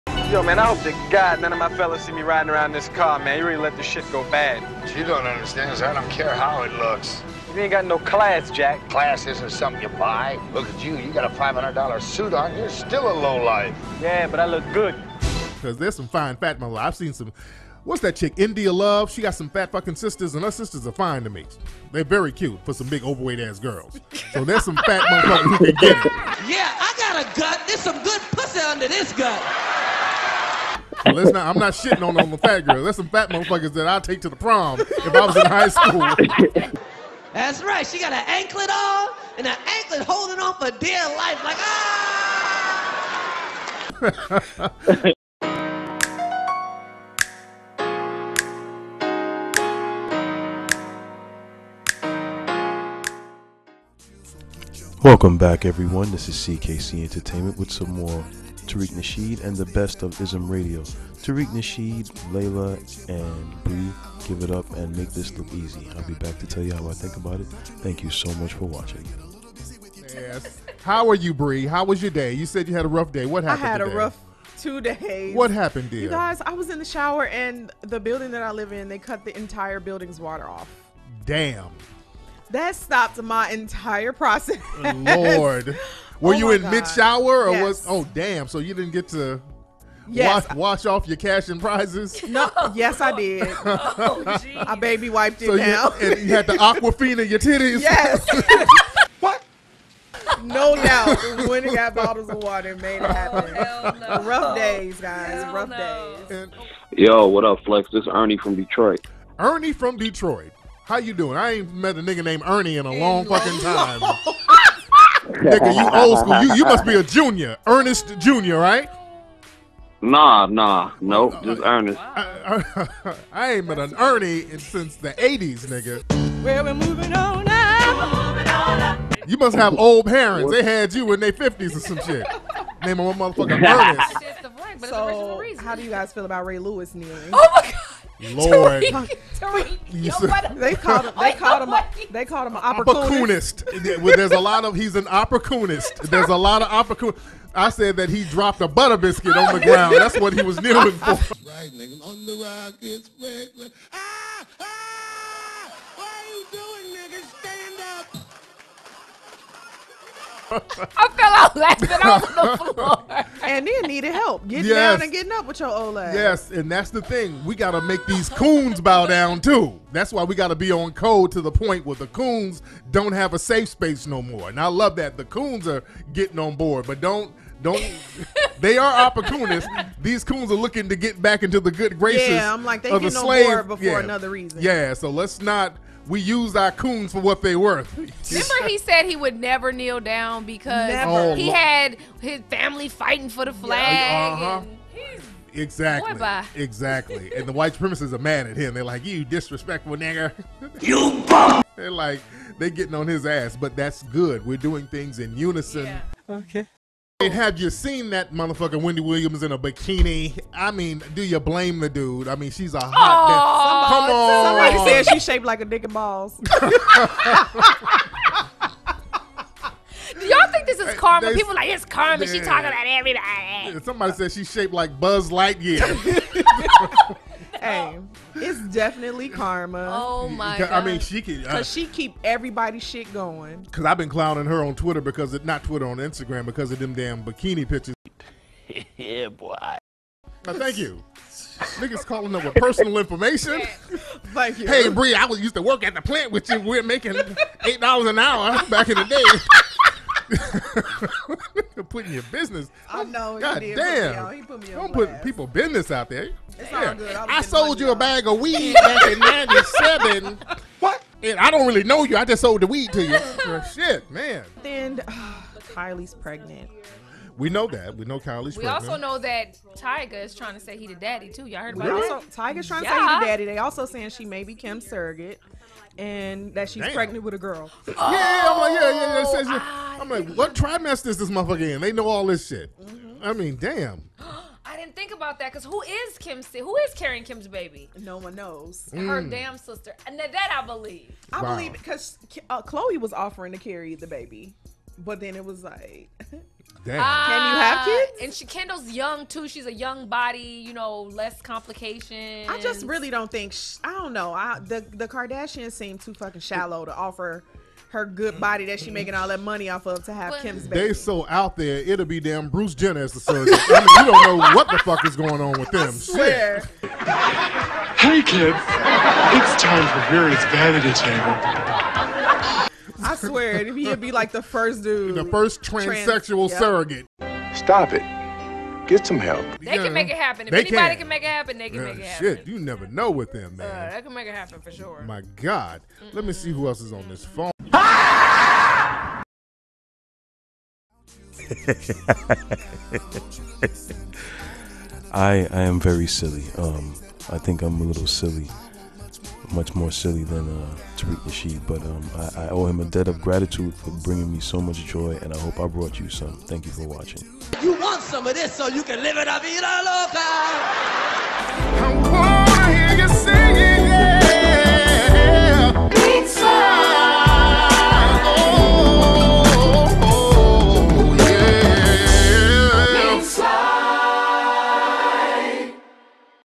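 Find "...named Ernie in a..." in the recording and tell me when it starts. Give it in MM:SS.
01:52.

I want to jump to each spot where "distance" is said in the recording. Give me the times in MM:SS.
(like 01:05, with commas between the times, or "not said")
not said.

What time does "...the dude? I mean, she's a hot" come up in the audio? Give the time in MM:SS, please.
03:31.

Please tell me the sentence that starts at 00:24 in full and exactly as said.
So there's some fat motherfuckers who can get Yeah, I got a gut.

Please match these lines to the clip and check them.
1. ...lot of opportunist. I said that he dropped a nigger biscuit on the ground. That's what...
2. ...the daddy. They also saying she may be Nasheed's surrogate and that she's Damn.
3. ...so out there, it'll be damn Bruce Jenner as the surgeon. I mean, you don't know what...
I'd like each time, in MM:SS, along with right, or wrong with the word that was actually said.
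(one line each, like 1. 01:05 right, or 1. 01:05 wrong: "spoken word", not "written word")
1. 02:26 wrong: "butter", not "nigger"
2. 04:33 wrong: "Kim", not "Nasheed"
3. 05:10 right.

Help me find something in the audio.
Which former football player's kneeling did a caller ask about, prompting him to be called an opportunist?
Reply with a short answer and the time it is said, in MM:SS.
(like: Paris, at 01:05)
Ray Lewis, at 02:16.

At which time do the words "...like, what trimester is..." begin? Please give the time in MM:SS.
04:40.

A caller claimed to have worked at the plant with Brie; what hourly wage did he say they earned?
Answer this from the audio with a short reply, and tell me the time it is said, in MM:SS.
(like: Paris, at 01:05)
8 dollars, at 04:07.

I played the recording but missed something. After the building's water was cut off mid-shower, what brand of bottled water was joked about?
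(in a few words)
Aquafina.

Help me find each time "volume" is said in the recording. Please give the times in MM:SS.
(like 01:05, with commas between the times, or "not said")
not said.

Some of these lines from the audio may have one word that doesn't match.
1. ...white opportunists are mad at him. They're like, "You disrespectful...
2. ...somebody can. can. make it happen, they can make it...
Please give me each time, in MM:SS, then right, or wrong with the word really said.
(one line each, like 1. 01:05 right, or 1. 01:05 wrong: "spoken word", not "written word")
1. 03:17 wrong: "supremacists", not "opportunists"
2. 05:30 wrong: "anybody", not "somebody".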